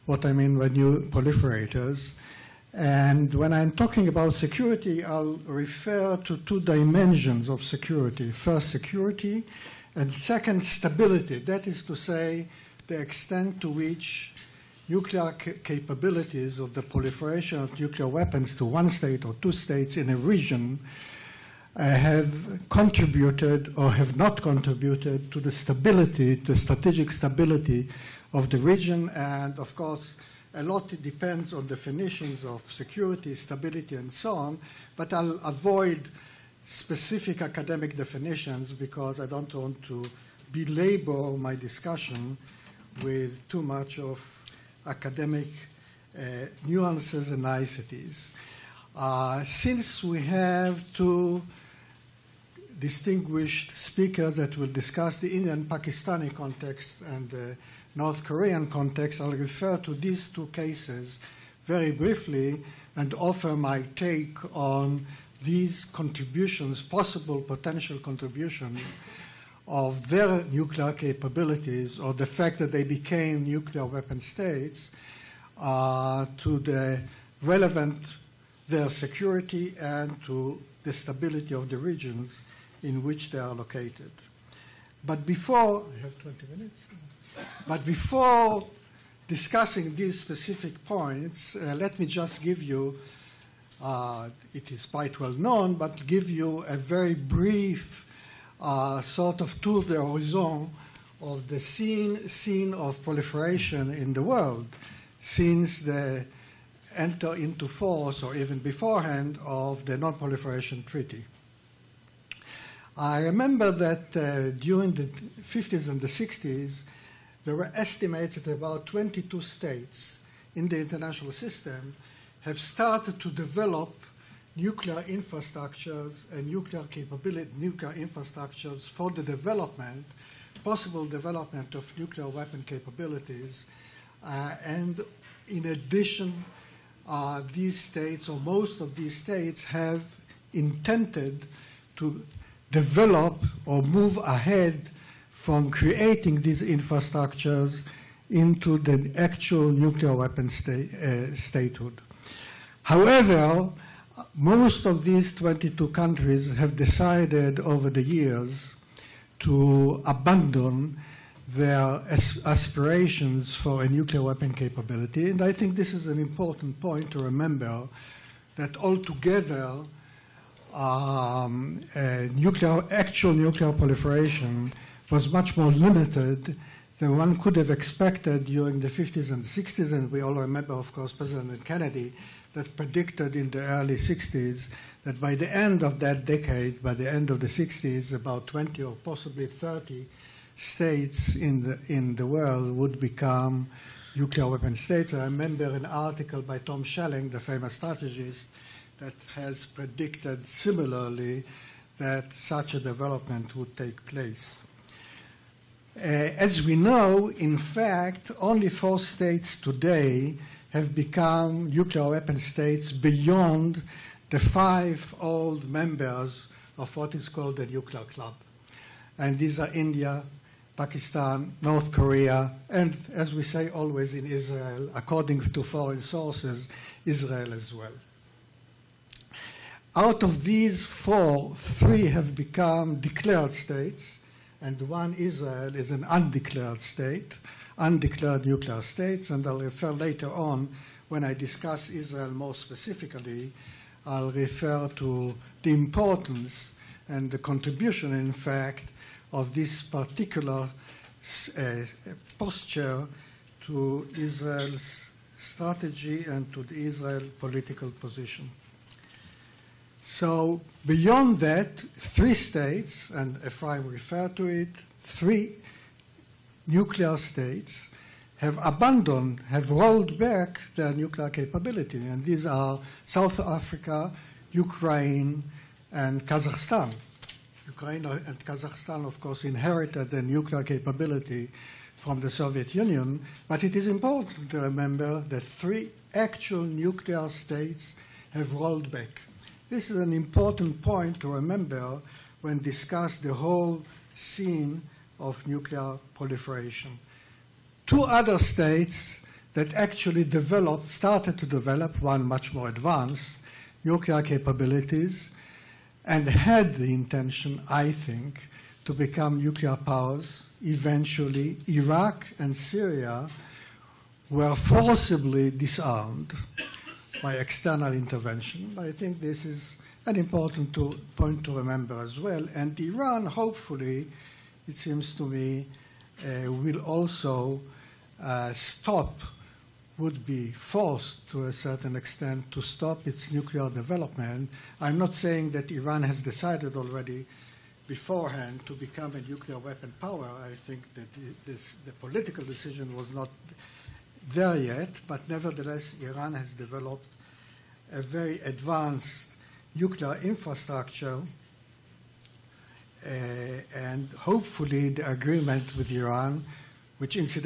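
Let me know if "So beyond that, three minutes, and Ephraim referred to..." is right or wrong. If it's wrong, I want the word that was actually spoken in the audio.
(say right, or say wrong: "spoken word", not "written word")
wrong: "states", not "minutes".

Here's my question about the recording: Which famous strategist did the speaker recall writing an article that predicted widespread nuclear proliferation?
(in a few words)
Tom Schelling.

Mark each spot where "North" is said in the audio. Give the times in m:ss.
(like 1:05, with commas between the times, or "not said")
0:57, 3:41.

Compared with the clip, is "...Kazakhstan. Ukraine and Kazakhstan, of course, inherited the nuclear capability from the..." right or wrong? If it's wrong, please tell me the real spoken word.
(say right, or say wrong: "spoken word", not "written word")
right.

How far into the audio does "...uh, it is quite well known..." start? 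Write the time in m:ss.
1:33.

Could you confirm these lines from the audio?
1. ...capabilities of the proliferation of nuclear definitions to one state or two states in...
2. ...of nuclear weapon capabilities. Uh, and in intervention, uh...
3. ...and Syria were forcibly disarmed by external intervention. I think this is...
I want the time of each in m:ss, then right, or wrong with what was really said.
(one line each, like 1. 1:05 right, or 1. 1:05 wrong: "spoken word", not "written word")
1. 0:15 wrong: "weapons", not "definitions"
2. 2:11 wrong: "addition", not "intervention"
3. 5:12 right.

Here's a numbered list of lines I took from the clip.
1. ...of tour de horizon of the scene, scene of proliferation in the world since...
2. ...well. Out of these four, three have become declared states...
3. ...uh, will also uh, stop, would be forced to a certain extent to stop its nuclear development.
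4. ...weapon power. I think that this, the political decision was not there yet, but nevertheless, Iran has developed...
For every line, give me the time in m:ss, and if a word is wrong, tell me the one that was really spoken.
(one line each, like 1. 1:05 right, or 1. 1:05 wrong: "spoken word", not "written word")
1. 1:39 right
2. 3:47 right
3. 5:26 right
4. 5:39 right.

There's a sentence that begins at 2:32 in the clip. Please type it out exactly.
However, most of these 22 countries have decided over the years to abandon their aspirations for a nuclear weapon capability.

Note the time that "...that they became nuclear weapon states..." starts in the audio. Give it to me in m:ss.
1:12.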